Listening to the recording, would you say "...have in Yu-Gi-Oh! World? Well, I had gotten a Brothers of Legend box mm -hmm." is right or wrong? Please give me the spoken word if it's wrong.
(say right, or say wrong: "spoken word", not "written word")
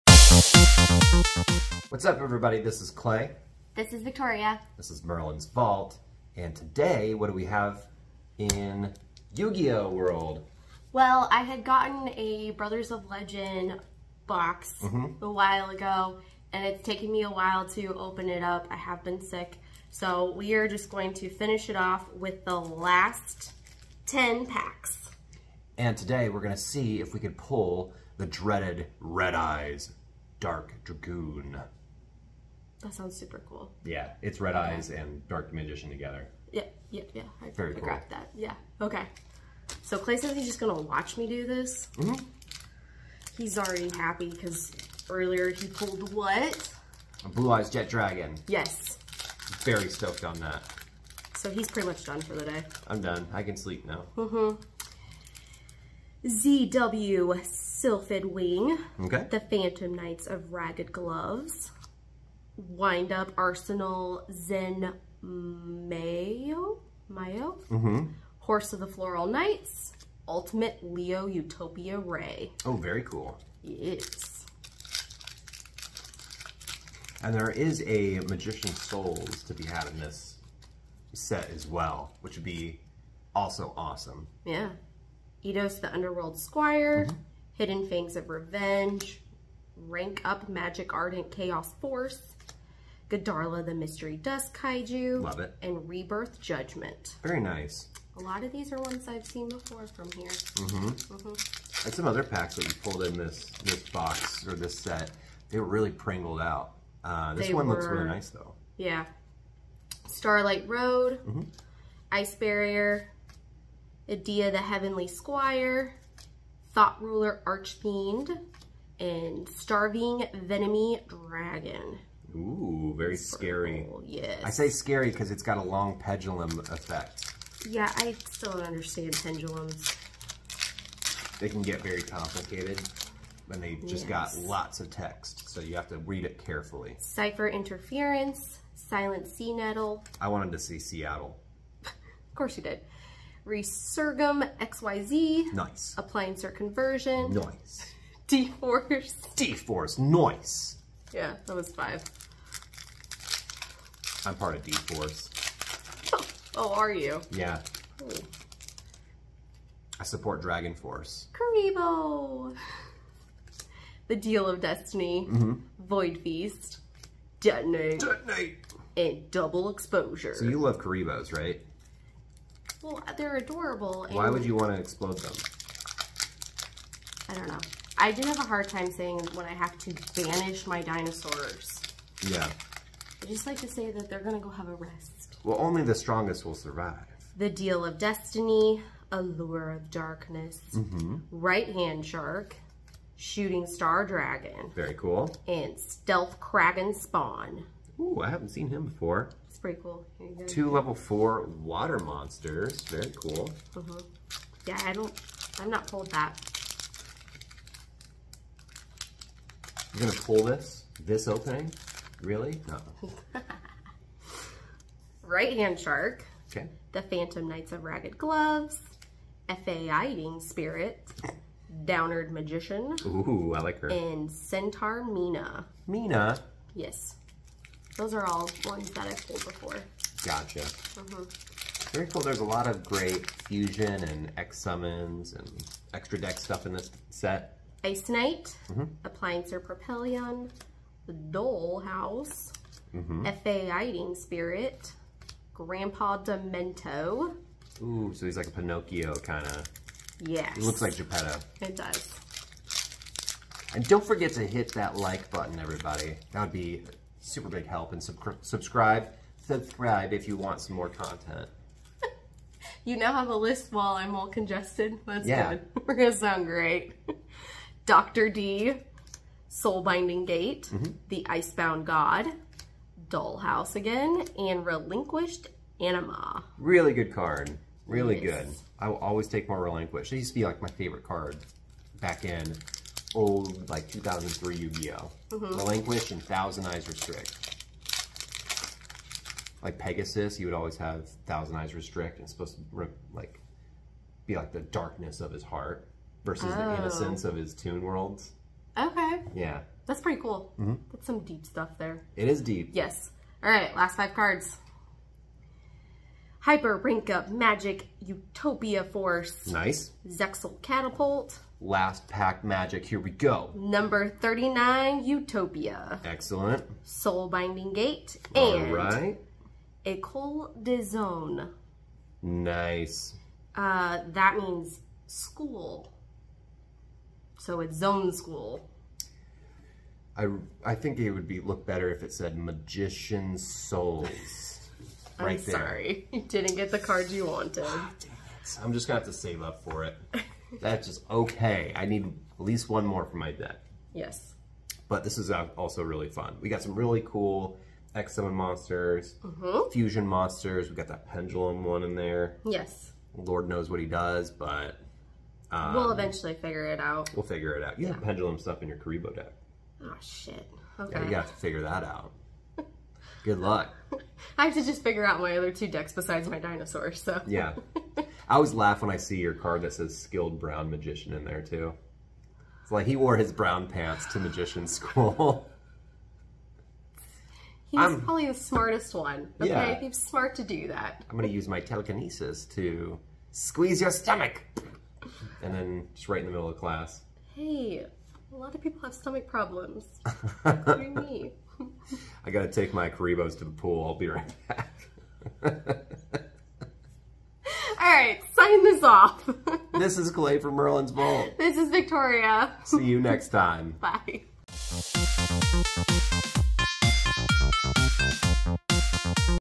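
right.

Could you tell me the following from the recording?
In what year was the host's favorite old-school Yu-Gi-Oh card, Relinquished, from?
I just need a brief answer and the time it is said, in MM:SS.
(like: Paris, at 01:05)
2003, at 04:43.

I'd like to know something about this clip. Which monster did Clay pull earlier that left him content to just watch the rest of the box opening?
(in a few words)
Blue Eyes Jet Dragon.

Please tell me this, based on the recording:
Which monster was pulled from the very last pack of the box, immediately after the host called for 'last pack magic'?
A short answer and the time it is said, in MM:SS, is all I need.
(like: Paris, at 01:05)
Number 39 Utopia, at 05:13.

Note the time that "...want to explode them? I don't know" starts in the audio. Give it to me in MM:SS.
02:54.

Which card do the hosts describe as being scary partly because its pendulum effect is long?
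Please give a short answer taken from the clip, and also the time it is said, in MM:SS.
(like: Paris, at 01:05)
Starving Venemy Dragon, at 01:59.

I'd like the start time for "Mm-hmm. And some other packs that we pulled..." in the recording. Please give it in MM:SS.
01:40.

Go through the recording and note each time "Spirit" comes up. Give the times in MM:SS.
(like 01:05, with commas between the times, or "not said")
03:40, 04:04.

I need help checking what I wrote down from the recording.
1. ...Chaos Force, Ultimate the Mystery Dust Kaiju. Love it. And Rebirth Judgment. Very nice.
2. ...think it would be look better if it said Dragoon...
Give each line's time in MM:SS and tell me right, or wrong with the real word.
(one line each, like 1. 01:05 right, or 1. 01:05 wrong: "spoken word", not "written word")
1. 01:31 wrong: "Gadarla", not "Ultimate"
2. 05:30 wrong: "Magician", not "Dragoon".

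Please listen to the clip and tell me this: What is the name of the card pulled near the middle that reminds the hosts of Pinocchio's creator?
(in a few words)
Grandpa Demetto.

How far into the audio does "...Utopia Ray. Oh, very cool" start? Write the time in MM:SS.
01:11.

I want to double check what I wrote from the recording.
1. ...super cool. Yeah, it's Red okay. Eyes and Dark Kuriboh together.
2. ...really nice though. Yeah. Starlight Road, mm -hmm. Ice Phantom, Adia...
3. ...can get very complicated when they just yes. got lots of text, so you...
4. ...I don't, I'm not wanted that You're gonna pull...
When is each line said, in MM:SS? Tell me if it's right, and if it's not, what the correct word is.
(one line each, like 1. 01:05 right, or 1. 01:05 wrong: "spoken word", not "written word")
1. 00:33 wrong: "Magician", not "Kuriboh"
2. 01:47 wrong: "Barrier", not "Phantom"
3. 02:11 right
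4. 03:24 wrong: "pulled", not "wanted".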